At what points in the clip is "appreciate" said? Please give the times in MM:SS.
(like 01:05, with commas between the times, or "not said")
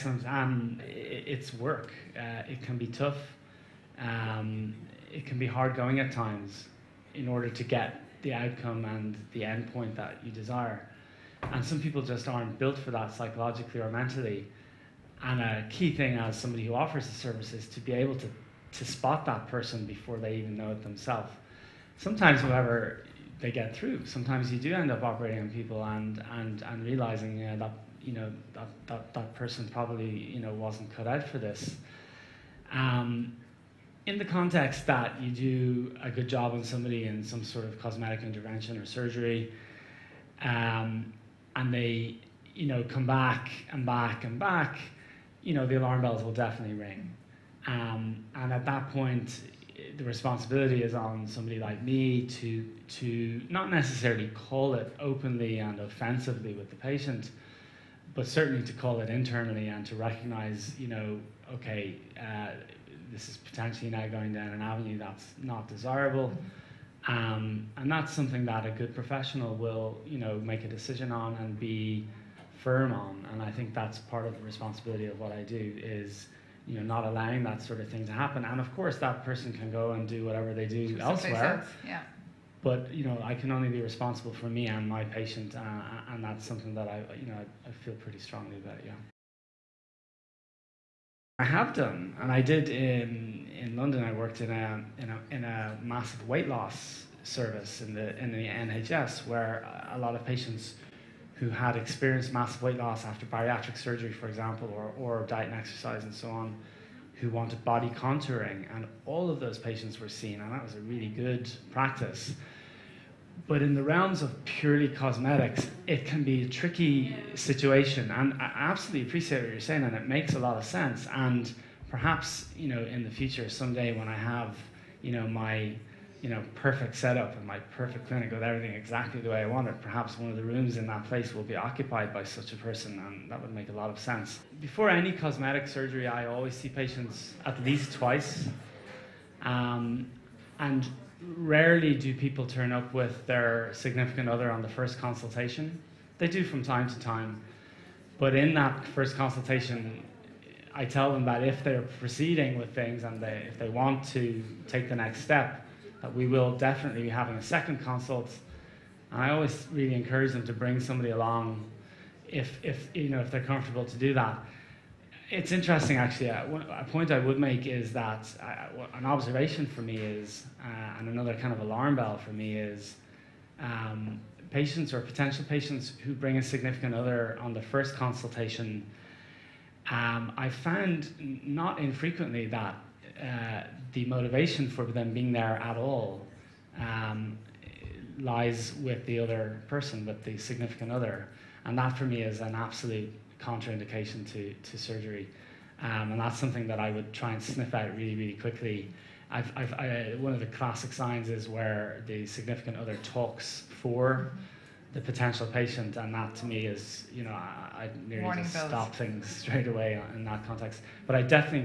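01:59.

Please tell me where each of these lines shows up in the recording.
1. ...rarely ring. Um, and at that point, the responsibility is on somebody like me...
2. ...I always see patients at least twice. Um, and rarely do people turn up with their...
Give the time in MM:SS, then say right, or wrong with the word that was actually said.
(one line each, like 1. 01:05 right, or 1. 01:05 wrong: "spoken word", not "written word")
1. 00:46 wrong: "definitely", not "rarely"
2. 02:16 right.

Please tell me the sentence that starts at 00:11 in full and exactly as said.
And some people just aren't built for that psychologically or mentally.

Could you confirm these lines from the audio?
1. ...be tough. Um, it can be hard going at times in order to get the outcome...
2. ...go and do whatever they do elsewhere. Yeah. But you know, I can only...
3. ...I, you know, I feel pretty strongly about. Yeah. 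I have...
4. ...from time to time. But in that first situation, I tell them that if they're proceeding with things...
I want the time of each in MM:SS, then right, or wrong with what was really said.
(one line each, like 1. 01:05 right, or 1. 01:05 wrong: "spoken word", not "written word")
1. 00:02 right
2. 01:19 right
3. 01:26 right
4. 02:26 wrong: "consultation", not "situation".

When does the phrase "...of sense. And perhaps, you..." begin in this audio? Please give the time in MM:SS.
02:00.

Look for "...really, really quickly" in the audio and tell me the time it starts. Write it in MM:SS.
03:17.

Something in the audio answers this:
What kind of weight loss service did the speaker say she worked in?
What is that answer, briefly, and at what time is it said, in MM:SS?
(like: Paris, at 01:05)
Massive weight loss service, at 01:35.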